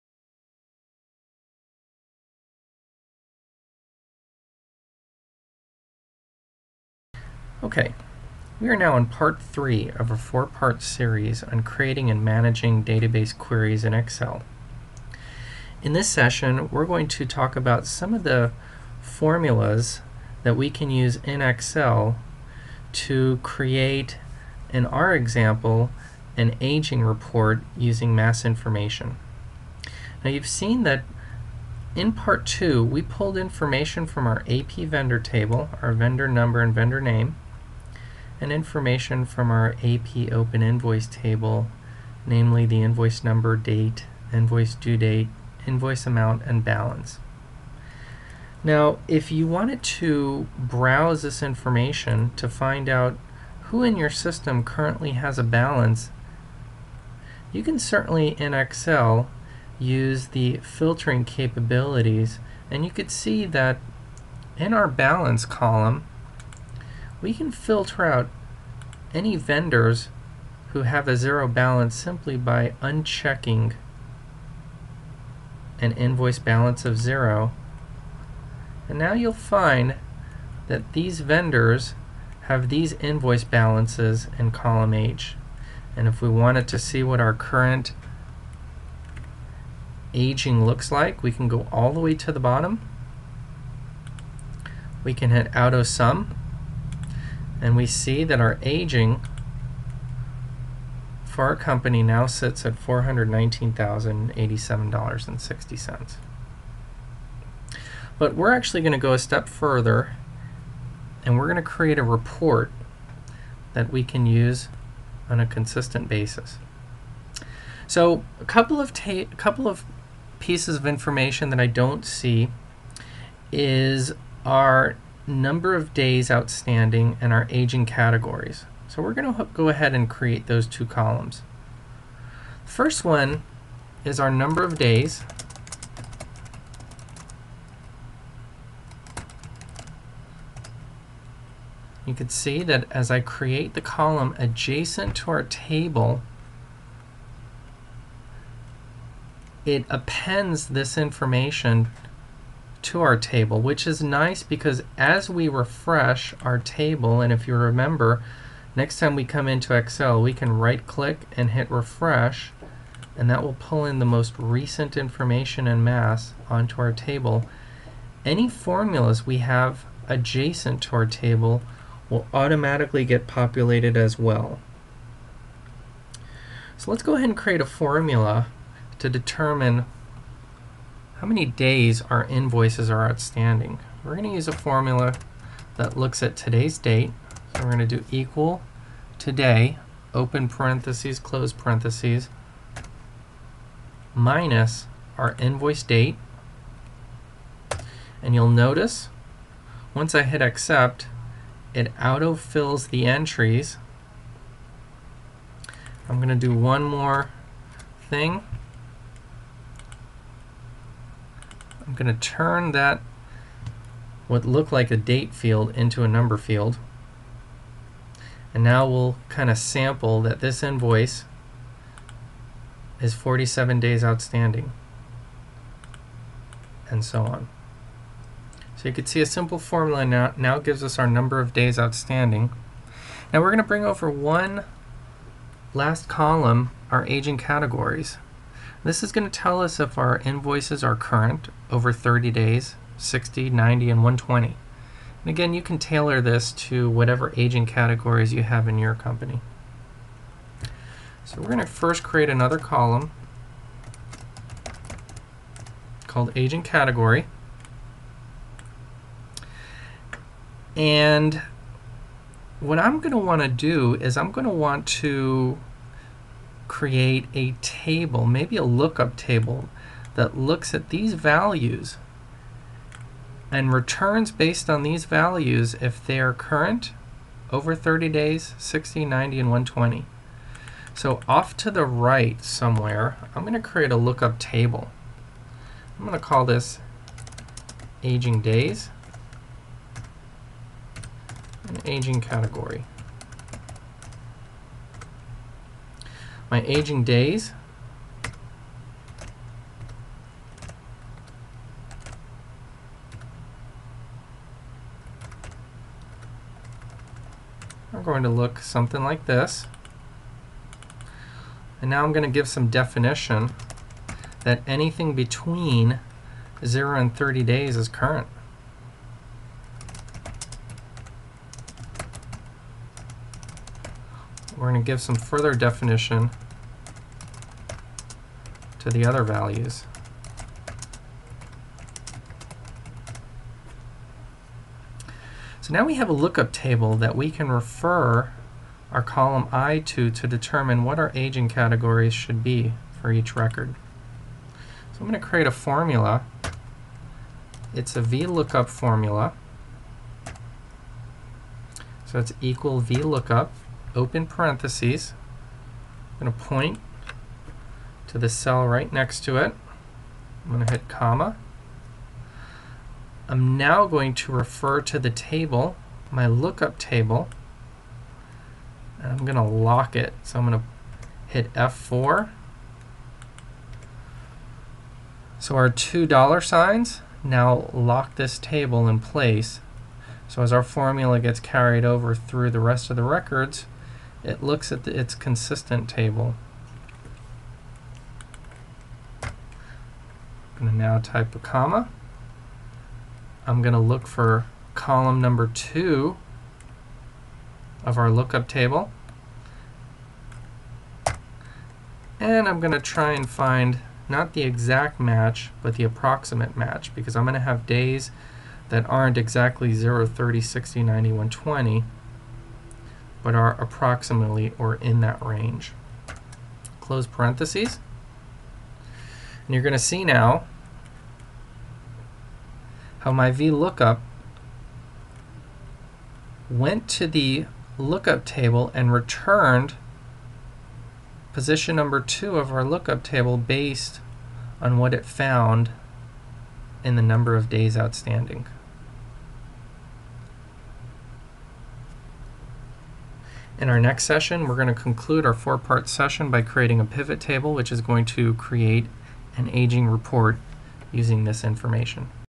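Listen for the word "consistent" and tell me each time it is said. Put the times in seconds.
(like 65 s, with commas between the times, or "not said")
115 s, 385 s.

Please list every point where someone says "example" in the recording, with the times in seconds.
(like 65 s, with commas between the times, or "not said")
25 s.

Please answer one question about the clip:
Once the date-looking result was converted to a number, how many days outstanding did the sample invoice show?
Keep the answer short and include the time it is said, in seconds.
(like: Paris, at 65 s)
47 days, at 223 s.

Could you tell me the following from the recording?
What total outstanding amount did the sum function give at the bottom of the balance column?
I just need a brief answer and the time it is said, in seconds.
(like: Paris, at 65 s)
$419,087.60, at 102 s.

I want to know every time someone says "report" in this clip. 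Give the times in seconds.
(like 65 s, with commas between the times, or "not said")
27 s, 112 s, 449 s.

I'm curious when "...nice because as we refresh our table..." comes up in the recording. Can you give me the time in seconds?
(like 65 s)
154 s.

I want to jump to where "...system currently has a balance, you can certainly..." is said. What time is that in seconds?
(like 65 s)
54 s.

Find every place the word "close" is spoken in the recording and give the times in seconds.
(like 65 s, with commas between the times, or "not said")
191 s, 416 s.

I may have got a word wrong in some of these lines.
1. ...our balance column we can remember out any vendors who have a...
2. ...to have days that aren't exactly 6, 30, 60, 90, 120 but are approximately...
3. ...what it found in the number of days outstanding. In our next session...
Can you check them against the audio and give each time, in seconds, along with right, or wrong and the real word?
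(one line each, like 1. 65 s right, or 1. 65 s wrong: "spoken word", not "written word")
1. 64 s wrong: "filter", not "remember"
2. 407 s wrong: "0", not "6"
3. 434 s right.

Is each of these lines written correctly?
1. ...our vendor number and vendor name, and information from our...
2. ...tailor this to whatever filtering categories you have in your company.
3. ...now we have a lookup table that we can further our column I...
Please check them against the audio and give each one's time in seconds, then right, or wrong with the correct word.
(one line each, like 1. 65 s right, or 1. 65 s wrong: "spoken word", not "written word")
1. 35 s right
2. 245 s wrong: "aging", not "filtering"
3. 335 s wrong: "refer", not "further".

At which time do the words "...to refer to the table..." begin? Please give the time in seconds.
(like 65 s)
364 s.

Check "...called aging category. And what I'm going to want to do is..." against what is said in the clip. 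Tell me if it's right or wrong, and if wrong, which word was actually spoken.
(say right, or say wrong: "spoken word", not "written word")
right.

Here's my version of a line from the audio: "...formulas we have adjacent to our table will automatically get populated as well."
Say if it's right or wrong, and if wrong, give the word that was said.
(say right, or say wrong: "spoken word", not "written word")
right.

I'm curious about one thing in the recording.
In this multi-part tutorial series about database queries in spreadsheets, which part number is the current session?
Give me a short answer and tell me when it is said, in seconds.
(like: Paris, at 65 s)
Part three, at 9 s.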